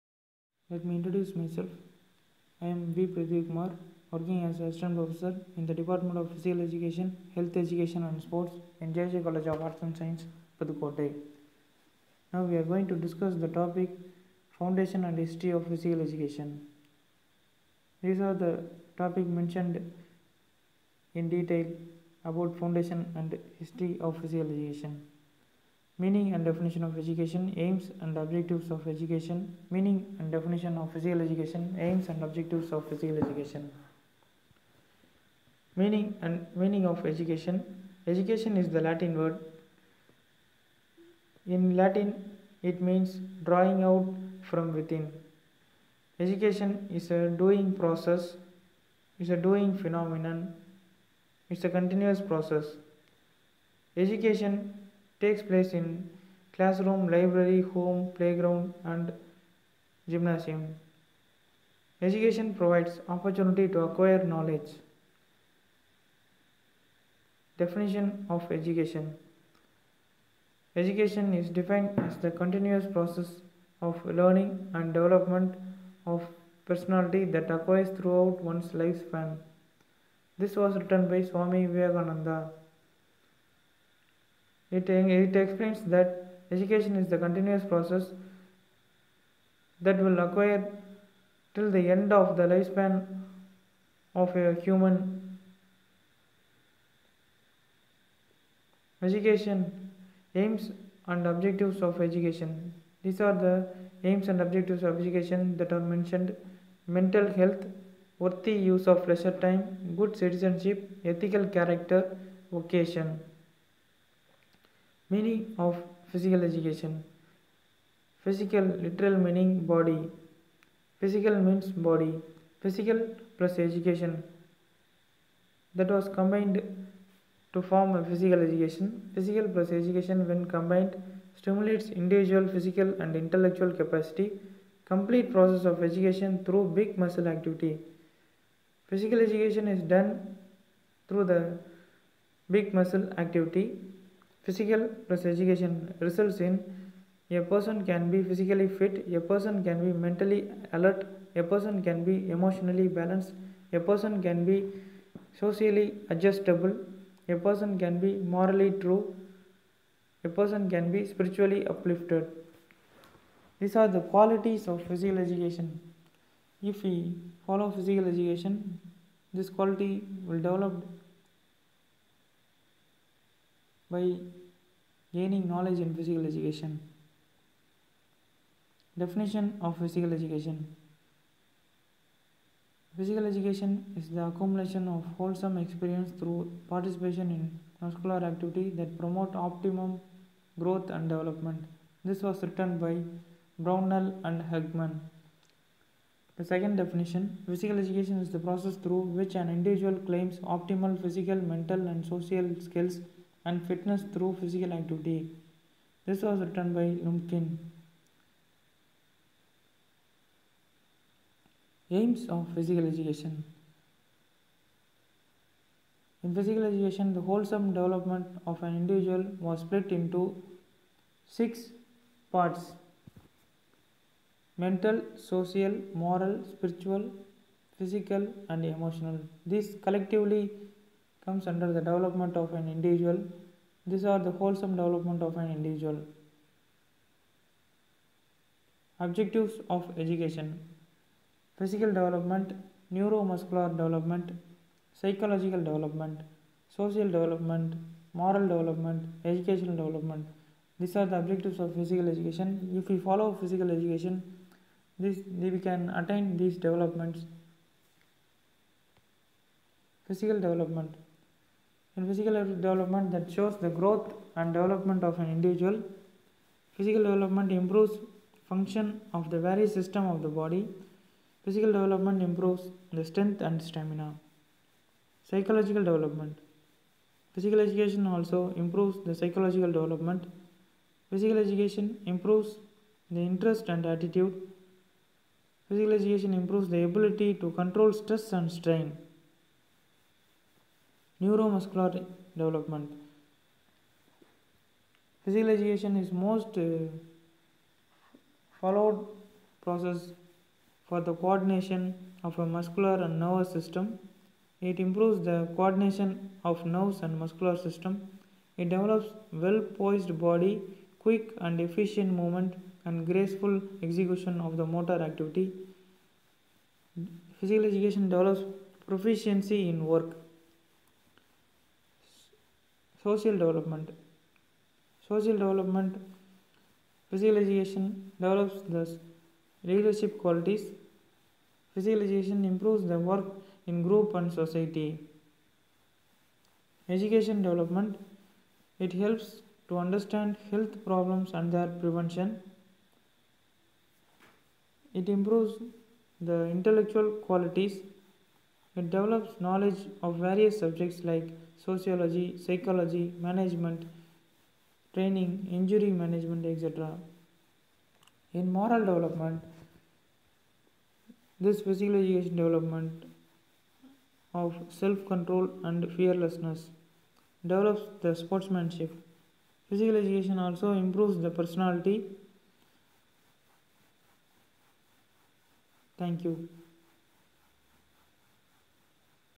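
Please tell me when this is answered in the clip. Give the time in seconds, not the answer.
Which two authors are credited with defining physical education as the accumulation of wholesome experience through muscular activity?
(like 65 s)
193 s.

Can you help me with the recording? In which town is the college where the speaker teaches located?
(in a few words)
Pudukkottai.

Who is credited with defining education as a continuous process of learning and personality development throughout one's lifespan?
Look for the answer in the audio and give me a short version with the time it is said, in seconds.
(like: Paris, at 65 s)
Swami Vivekananda, at 81 s.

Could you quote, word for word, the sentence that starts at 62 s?
Education provides opportunity to acquire knowledge.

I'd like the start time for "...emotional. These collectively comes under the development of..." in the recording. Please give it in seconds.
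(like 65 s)
228 s.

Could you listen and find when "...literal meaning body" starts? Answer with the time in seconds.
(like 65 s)
118 s.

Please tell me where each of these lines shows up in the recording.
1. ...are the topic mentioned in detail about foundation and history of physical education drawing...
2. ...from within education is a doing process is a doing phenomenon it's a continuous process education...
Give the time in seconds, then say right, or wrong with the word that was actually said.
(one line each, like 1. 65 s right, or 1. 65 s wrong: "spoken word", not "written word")
1. 18 s wrong: "meaning", not "drawing"
2. 44 s right.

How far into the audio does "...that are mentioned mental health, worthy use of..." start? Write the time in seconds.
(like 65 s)
105 s.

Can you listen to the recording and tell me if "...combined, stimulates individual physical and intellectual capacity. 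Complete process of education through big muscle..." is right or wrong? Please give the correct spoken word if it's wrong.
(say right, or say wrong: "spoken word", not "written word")
right.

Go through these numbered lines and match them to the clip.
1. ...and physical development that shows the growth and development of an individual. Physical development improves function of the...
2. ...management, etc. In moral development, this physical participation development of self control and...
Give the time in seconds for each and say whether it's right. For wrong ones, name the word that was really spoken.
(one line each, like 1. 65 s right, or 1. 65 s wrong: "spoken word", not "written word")
1. 262 s right
2. 355 s wrong: "education", not "participation".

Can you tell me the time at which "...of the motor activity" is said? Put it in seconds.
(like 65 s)
314 s.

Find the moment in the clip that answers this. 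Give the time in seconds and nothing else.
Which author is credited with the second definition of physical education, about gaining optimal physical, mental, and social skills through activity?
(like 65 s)
207 s.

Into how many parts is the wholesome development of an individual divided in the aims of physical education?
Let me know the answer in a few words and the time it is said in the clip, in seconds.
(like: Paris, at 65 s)
6, at 221 s.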